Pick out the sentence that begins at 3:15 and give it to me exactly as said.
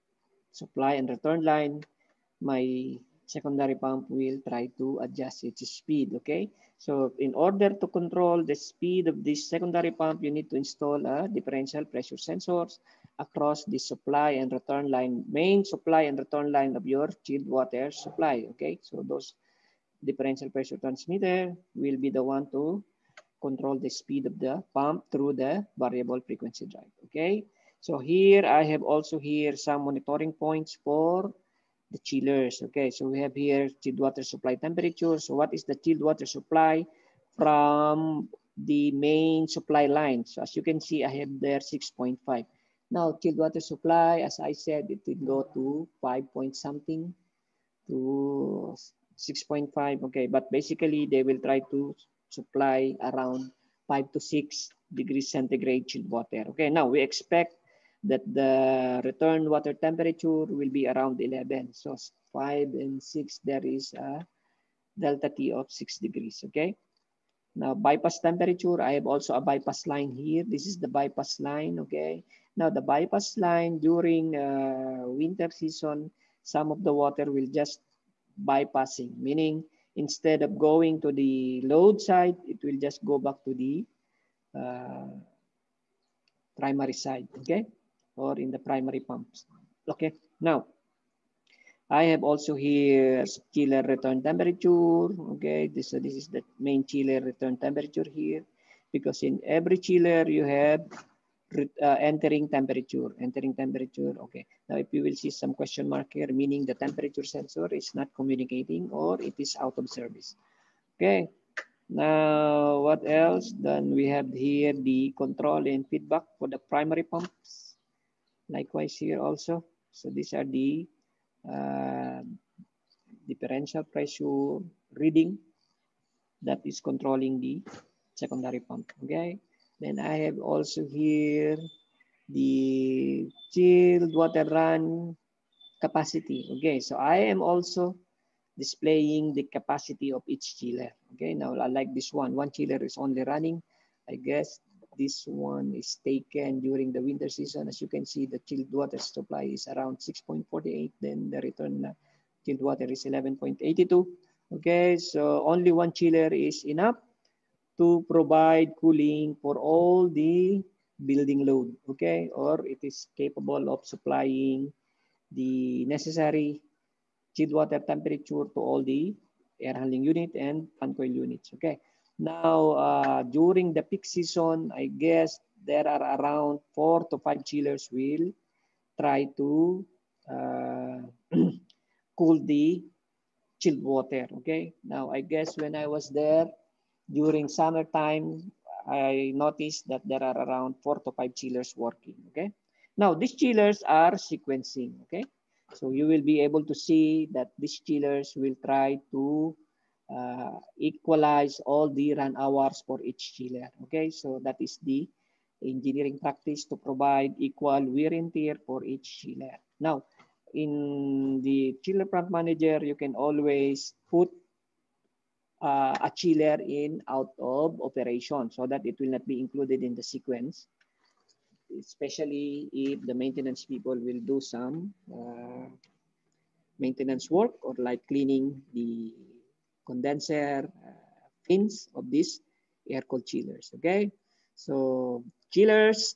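So you will be able to see that these chillers will try to uh, equalize all the run hours for each chiller.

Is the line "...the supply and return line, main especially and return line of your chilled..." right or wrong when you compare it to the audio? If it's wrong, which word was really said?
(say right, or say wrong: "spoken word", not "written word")
wrong: "supply", not "especially".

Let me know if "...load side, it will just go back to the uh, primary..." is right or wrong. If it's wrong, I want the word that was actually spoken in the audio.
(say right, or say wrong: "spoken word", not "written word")
right.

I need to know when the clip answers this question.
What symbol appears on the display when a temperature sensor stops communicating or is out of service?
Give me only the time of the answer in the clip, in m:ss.
1:45.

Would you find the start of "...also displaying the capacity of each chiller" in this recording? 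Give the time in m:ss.
2:17.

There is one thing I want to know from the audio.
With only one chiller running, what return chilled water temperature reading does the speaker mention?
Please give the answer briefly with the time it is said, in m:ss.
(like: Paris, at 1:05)
11.82, at 2:33.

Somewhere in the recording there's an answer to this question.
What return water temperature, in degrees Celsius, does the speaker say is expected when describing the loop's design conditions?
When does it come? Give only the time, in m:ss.
1:00.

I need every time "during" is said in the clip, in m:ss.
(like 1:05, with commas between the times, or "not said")
1:13, 2:26, 2:53, 3:07.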